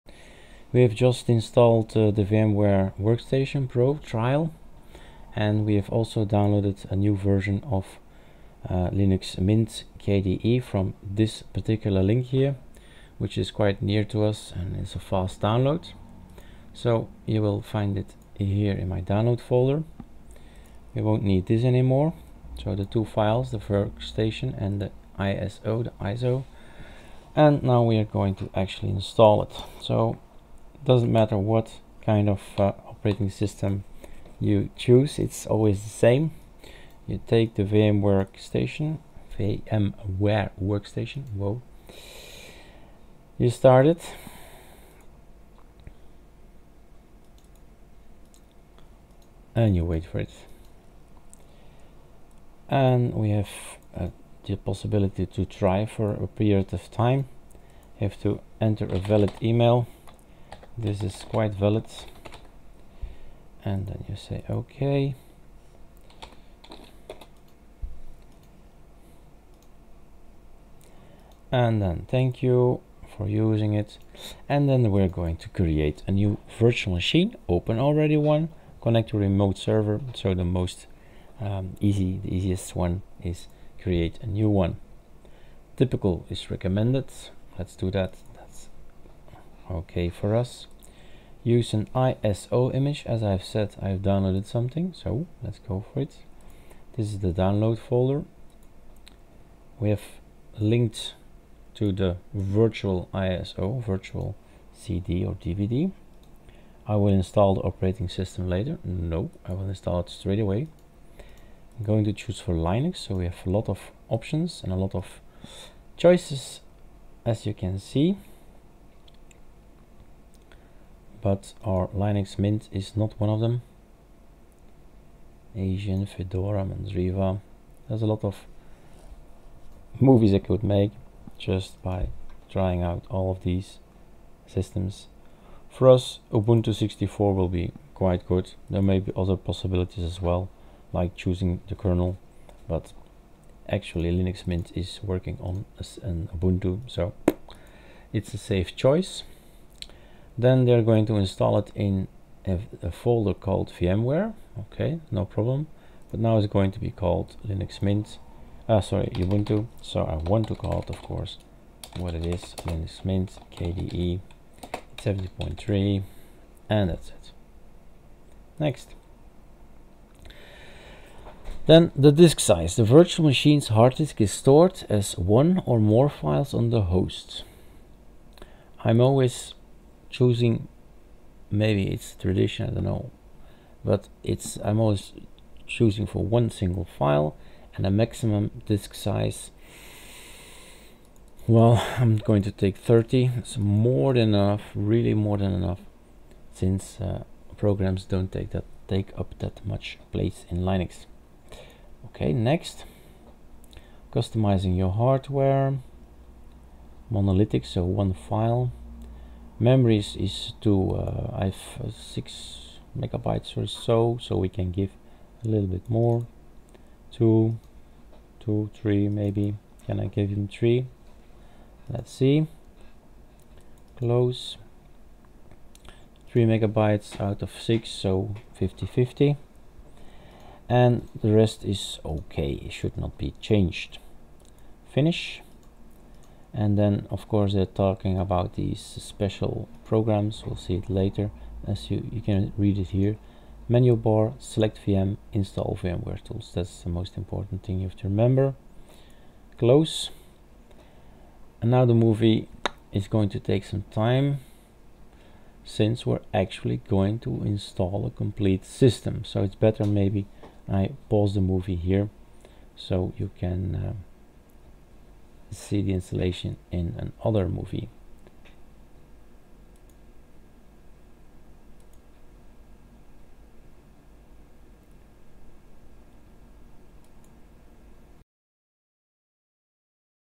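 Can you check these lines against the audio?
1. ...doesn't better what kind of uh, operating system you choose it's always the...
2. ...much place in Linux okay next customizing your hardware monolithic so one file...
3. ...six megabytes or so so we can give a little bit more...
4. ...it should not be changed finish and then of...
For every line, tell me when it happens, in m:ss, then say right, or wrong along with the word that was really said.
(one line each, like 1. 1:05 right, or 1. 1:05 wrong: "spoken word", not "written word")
1. 0:30 wrong: "matter", not "better"
2. 3:19 right
3. 3:31 right
4. 3:52 right.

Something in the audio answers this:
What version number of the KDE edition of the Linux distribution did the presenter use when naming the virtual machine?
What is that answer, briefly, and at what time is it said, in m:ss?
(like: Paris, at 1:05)
17.3, at 2:44.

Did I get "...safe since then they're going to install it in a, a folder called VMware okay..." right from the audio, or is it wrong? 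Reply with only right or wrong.
wrong.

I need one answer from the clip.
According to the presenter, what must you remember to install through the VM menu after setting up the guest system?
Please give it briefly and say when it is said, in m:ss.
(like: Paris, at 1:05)
VMware Tools, at 4:05.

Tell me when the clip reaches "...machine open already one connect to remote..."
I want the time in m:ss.
1:16.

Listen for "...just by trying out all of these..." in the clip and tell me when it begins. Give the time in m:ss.
2:11.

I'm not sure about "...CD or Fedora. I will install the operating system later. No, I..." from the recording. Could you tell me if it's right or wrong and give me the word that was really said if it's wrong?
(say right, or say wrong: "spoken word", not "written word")
wrong: "DVD", not "Fedora".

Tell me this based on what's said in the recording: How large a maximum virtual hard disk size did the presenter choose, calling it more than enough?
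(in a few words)
30.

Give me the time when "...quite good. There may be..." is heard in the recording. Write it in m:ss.
2:17.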